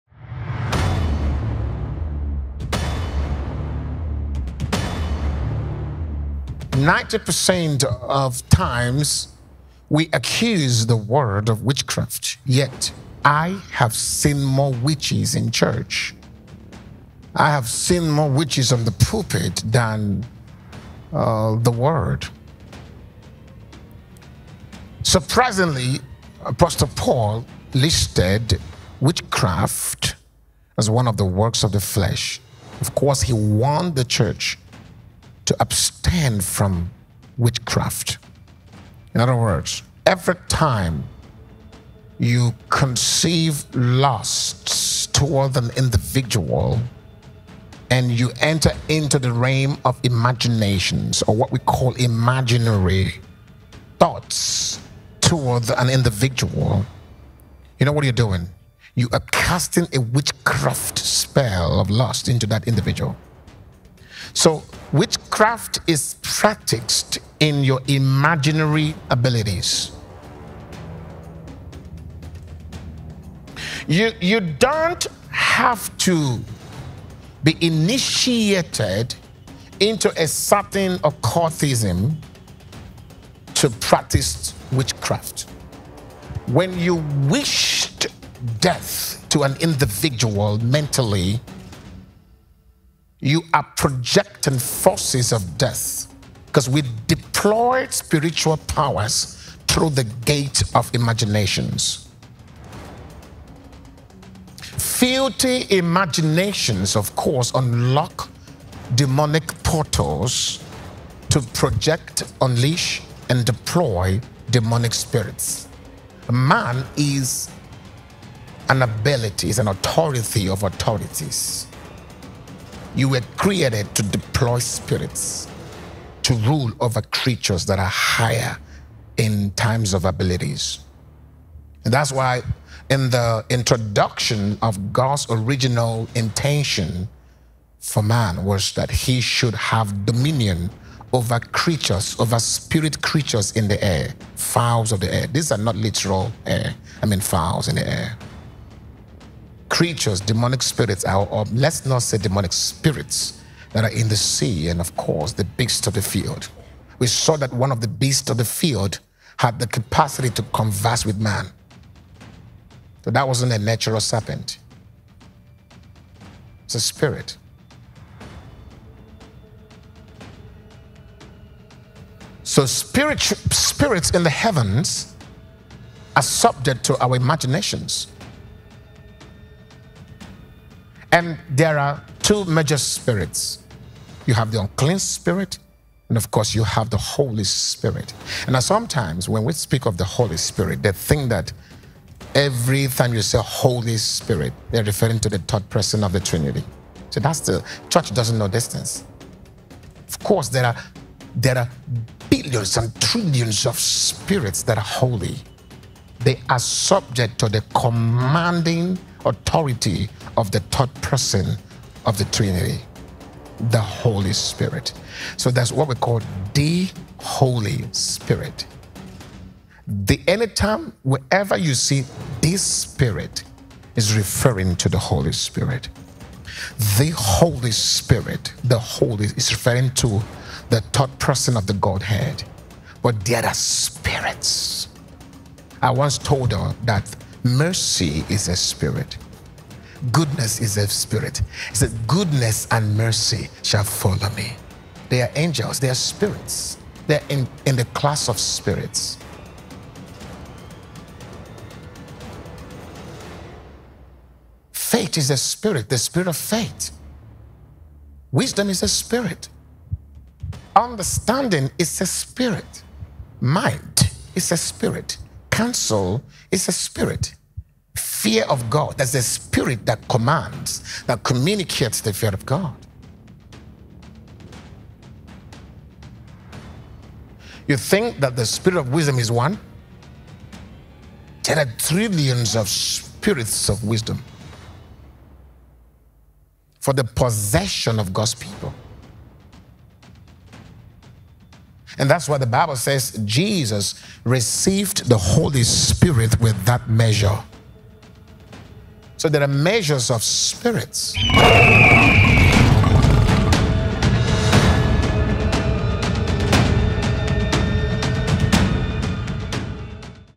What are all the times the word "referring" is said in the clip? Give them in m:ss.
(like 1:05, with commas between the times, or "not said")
3:14, 3:44, 3:49.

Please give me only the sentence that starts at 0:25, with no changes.
Surprisingly, Apostle Paul listed witchcraft as one of the works of the flesh.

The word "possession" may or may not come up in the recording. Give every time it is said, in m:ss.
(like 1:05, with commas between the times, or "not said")
4:47.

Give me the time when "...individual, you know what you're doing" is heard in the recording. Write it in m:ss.
0:55.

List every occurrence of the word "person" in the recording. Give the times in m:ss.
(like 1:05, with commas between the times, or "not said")
3:15, 3:30, 3:51.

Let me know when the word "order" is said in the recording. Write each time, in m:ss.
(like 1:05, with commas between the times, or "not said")
not said.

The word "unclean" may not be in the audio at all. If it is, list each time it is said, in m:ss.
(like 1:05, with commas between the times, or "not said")
3:04.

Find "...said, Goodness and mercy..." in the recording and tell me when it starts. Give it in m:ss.
4:01.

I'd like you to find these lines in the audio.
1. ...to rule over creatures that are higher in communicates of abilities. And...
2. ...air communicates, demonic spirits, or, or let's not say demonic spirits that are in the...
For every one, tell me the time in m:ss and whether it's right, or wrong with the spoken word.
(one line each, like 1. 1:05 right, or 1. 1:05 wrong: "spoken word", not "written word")
1. 2:06 wrong: "times", not "communicates"
2. 2:27 wrong: "creatures", not "communicates".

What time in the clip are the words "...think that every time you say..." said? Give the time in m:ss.
3:10.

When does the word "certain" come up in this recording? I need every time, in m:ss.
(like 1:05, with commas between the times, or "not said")
1:20.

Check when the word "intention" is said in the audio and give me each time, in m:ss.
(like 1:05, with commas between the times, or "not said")
2:16.